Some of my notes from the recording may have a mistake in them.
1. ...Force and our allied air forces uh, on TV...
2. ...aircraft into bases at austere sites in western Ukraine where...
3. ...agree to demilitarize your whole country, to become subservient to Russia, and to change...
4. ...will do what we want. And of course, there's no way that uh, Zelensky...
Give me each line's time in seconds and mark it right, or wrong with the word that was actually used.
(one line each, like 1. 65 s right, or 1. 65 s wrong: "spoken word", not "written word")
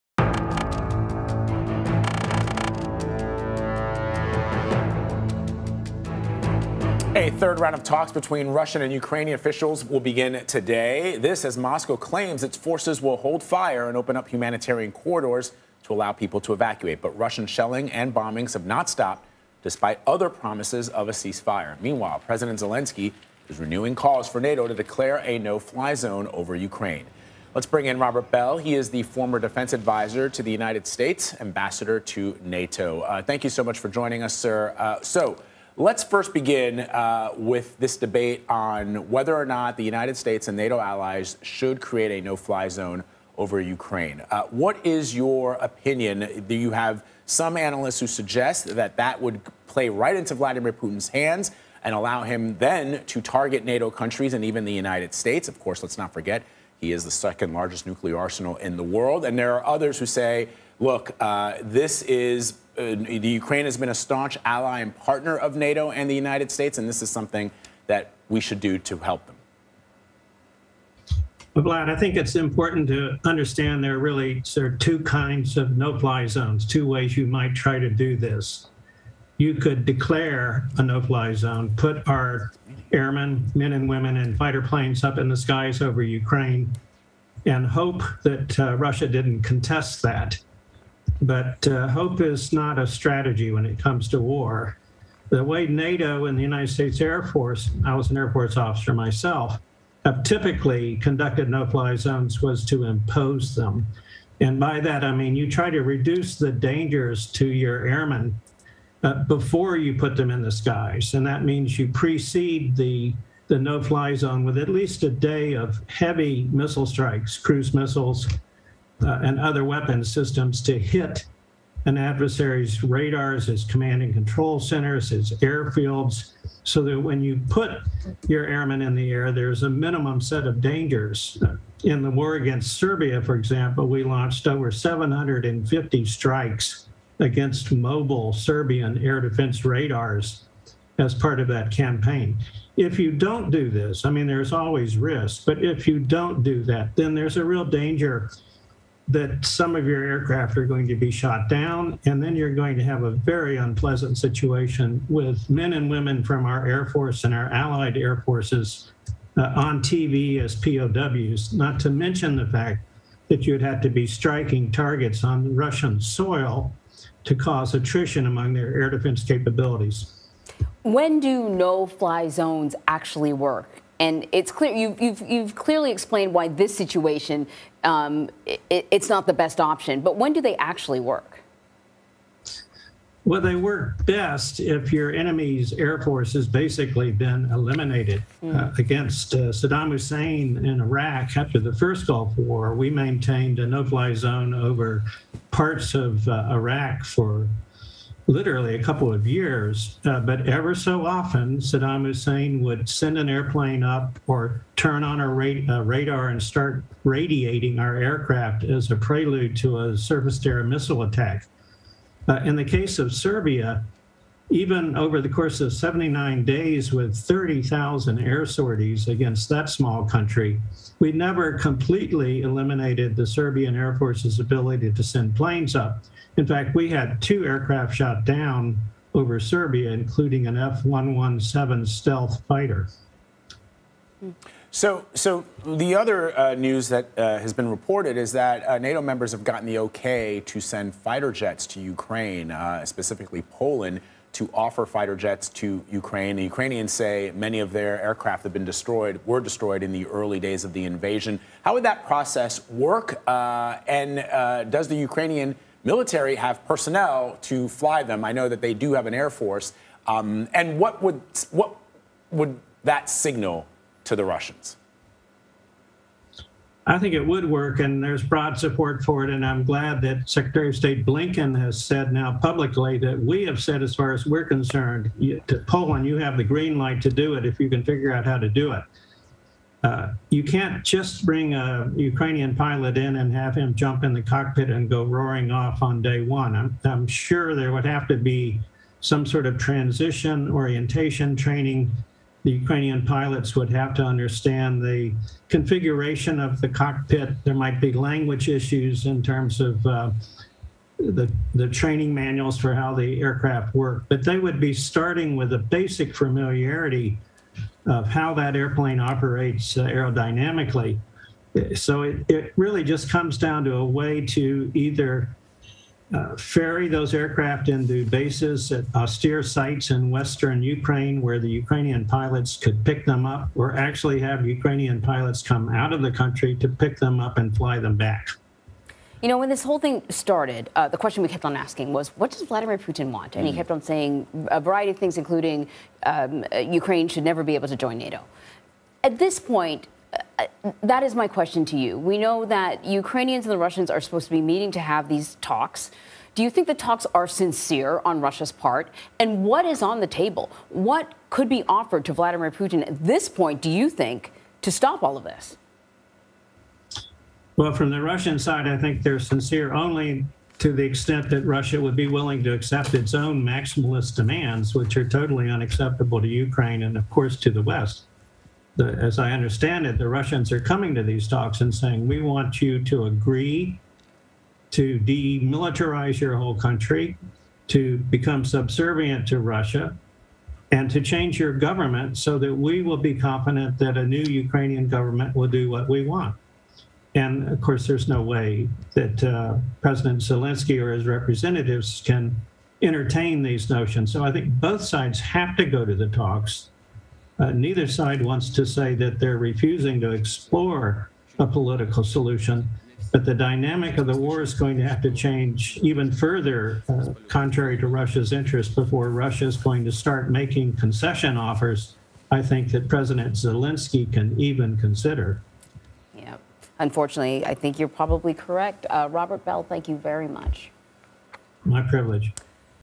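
1. 156 s right
2. 317 s right
3. 373 s right
4. 385 s wrong: "President", not "Zelensky".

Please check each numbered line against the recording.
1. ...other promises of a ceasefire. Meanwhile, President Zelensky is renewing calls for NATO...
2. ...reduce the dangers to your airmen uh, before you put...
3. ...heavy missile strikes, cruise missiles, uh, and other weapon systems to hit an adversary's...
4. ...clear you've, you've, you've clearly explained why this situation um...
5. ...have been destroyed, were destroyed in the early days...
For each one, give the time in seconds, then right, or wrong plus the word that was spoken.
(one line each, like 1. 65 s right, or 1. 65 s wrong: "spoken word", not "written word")
1. 20 s right
2. 105 s right
3. 115 s right
4. 174 s right
5. 248 s right.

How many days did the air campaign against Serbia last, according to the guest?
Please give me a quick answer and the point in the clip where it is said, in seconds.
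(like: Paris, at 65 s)
79, at 215 s.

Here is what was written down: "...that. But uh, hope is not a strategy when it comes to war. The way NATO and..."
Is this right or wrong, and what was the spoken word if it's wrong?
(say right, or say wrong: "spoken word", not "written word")
right.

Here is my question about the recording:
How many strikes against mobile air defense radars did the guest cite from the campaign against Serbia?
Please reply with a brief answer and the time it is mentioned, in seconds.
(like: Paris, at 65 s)
Over 750, at 134 s.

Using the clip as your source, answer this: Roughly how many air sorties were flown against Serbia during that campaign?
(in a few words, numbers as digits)
30,000.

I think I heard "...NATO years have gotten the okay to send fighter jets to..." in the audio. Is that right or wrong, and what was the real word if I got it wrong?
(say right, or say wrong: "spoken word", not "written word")
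wrong: "members", not "years".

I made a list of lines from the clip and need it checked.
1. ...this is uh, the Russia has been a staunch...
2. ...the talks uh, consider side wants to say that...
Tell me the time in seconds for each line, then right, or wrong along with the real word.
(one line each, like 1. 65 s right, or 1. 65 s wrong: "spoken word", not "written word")
1. 61 s wrong: "Ukraine", not "Russia"
2. 395 s wrong: "neither", not "consider".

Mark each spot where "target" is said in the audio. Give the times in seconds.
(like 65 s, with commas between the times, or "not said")
53 s, 164 s.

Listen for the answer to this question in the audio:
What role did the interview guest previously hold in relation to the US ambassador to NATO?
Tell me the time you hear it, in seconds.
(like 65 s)
29 s.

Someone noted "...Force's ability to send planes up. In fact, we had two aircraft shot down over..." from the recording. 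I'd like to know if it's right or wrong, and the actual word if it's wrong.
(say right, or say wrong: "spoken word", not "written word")
right.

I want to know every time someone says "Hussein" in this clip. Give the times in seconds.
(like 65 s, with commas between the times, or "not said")
189 s, 202 s.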